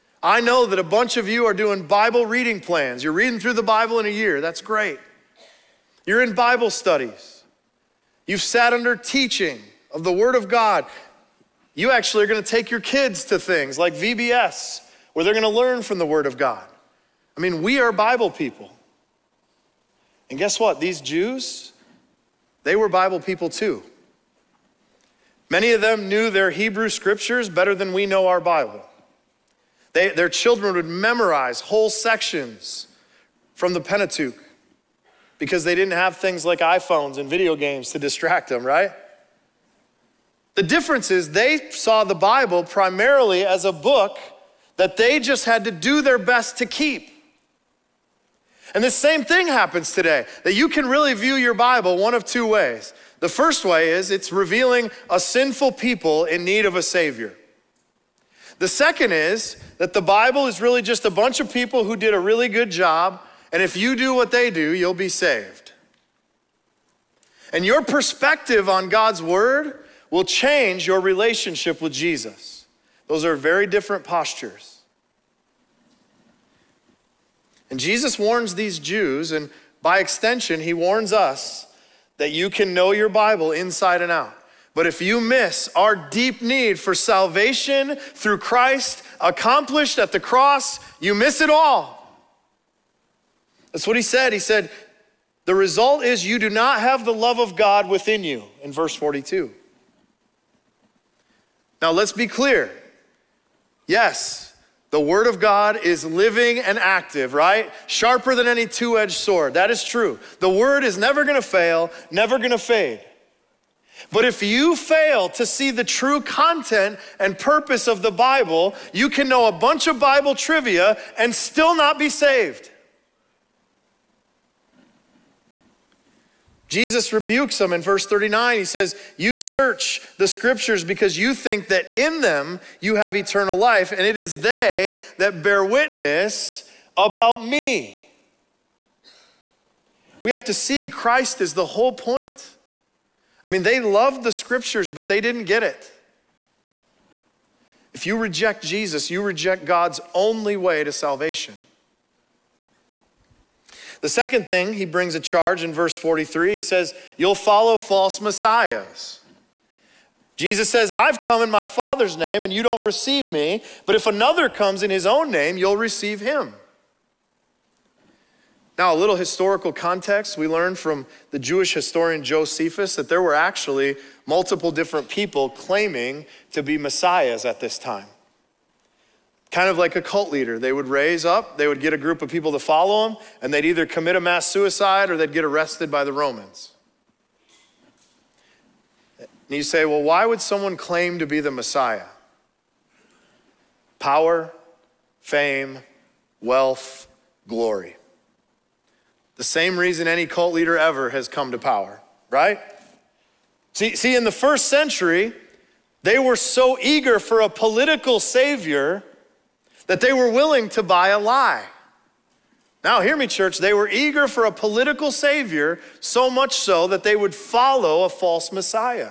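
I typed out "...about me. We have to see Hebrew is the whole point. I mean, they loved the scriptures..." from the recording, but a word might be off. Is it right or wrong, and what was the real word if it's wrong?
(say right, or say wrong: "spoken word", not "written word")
wrong: "Christ", not "Hebrew".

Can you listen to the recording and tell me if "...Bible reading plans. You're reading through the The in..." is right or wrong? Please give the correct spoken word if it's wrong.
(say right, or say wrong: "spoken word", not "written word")
wrong: "Bible", not "The".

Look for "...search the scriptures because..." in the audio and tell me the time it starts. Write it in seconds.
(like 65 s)
129 s.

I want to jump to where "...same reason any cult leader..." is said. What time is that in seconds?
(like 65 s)
199 s.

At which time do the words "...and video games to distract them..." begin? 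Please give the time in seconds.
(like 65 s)
37 s.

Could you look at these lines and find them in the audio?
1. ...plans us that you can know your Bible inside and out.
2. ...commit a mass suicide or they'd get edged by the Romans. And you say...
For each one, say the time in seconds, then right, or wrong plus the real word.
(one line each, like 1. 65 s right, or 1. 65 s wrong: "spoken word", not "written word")
1. 80 s wrong: "warns", not "plans"
2. 183 s wrong: "arrested", not "edged".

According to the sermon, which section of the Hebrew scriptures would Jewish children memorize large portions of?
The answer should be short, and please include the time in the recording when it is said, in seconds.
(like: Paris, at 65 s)
Pentateuch, at 33 s.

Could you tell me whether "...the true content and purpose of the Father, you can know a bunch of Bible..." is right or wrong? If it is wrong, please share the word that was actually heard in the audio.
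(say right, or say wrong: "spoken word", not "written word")
wrong: "Bible", not "Father".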